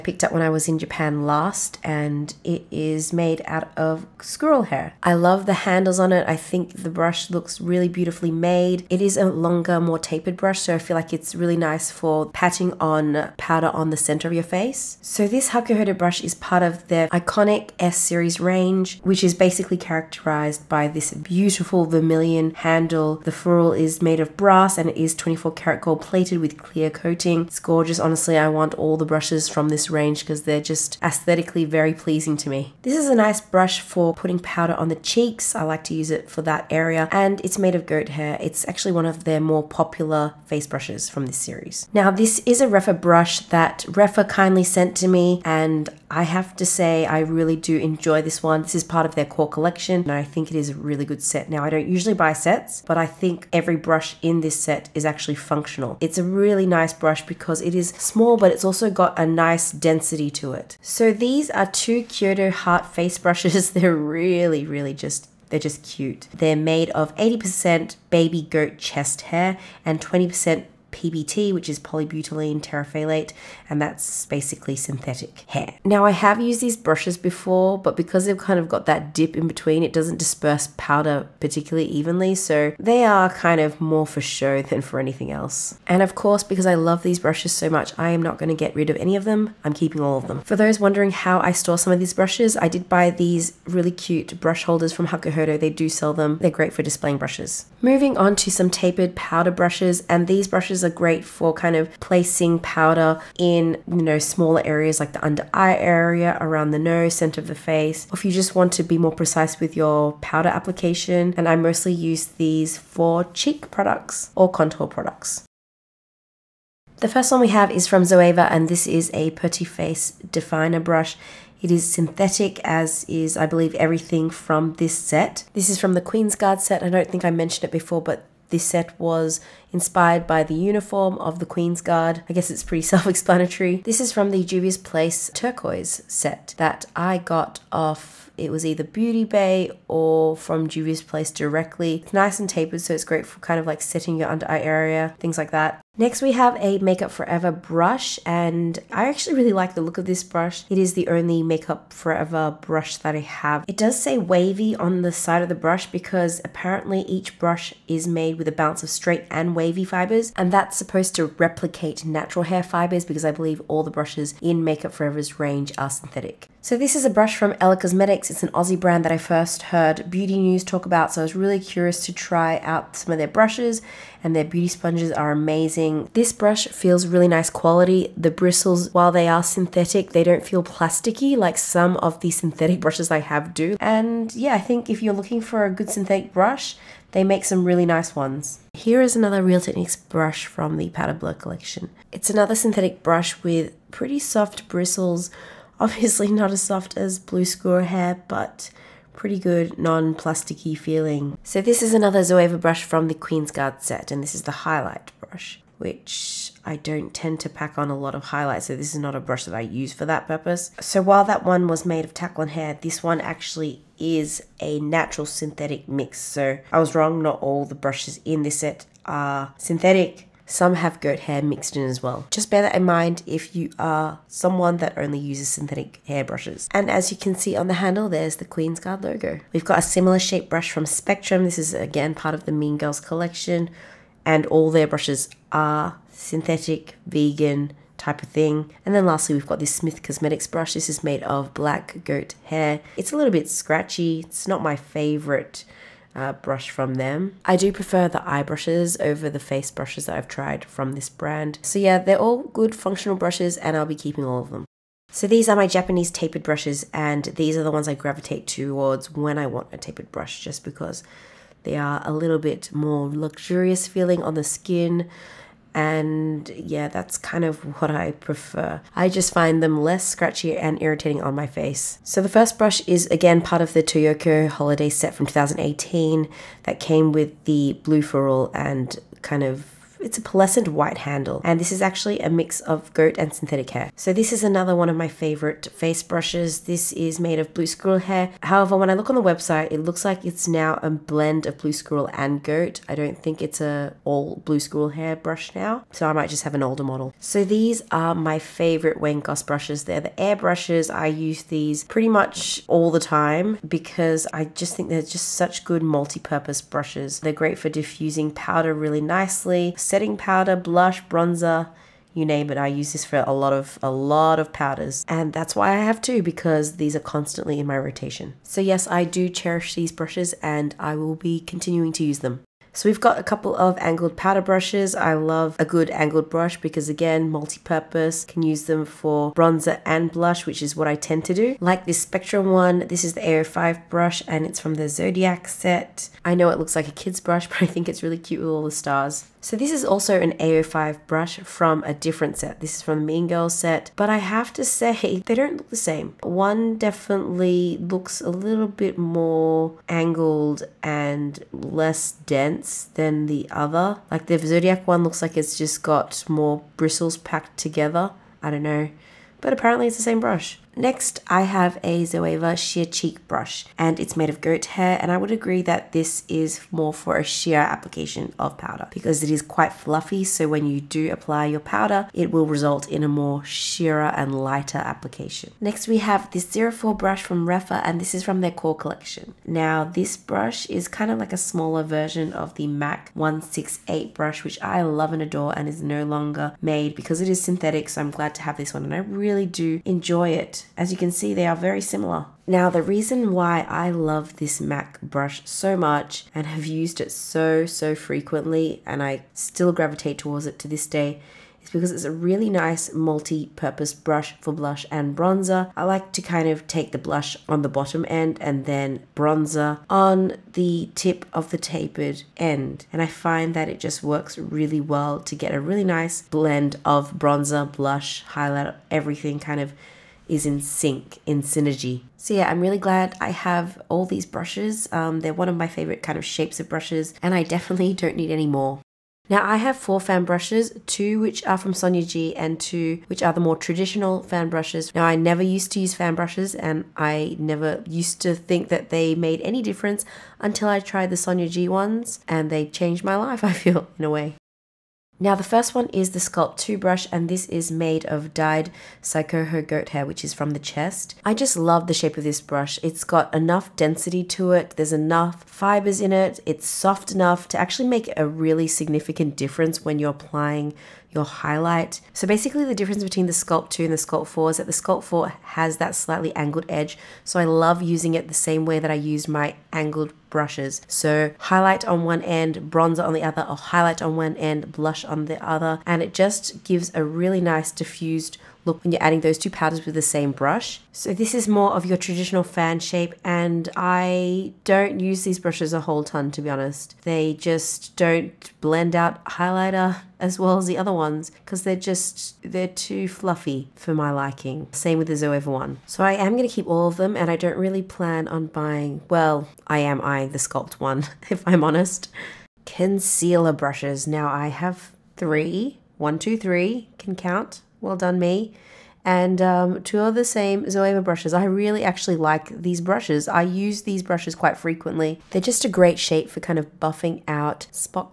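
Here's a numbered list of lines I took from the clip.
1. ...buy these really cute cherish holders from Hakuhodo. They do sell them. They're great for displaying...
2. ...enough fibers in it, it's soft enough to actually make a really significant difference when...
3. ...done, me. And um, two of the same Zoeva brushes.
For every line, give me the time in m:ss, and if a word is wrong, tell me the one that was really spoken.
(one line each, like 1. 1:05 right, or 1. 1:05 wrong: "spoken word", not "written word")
1. 1:32 wrong: "brush", not "cherish"
2. 7:34 right
3. 8:27 right.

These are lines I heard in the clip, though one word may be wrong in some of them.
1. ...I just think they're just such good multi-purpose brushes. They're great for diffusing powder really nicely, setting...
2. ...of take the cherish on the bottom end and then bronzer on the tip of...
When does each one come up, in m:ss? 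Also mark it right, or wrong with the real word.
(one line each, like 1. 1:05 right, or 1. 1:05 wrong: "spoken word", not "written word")
1. 5:04 right
2. 6:46 wrong: "blush", not "cherish".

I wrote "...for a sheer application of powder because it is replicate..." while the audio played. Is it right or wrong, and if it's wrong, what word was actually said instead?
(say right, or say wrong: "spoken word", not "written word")
wrong: "quite", not "replicate".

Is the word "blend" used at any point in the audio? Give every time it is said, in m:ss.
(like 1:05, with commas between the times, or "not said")
4:50, 6:56, 8:08.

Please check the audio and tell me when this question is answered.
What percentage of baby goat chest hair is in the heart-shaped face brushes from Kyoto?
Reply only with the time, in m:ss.
1:07.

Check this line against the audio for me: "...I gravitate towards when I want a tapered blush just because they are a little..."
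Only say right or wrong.
wrong.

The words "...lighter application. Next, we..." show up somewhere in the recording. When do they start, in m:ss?
6:14.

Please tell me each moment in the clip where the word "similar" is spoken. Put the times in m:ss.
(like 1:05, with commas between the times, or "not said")
3:49, 6:31.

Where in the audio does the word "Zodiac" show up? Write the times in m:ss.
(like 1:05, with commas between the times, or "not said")
5:34, 5:54.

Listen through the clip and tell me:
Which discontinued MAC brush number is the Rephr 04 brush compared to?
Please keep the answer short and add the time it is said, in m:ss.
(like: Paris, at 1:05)
168, at 6:22.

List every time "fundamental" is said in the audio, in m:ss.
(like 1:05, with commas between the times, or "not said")
not said.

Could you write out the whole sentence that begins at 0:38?
It's actually one of their more popular face brushes from this series.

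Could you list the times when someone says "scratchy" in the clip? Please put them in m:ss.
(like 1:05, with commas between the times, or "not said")
4:03, 4:30.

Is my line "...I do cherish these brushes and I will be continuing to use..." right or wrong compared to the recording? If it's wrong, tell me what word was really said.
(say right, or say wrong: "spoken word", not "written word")
right.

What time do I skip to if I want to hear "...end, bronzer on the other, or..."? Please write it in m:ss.
7:52.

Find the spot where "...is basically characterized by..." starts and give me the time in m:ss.
0:19.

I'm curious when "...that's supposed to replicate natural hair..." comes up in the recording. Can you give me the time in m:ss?
2:40.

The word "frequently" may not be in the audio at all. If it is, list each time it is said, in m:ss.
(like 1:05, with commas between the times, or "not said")
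6:37, 8:34.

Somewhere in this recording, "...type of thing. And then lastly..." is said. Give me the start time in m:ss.
3:57.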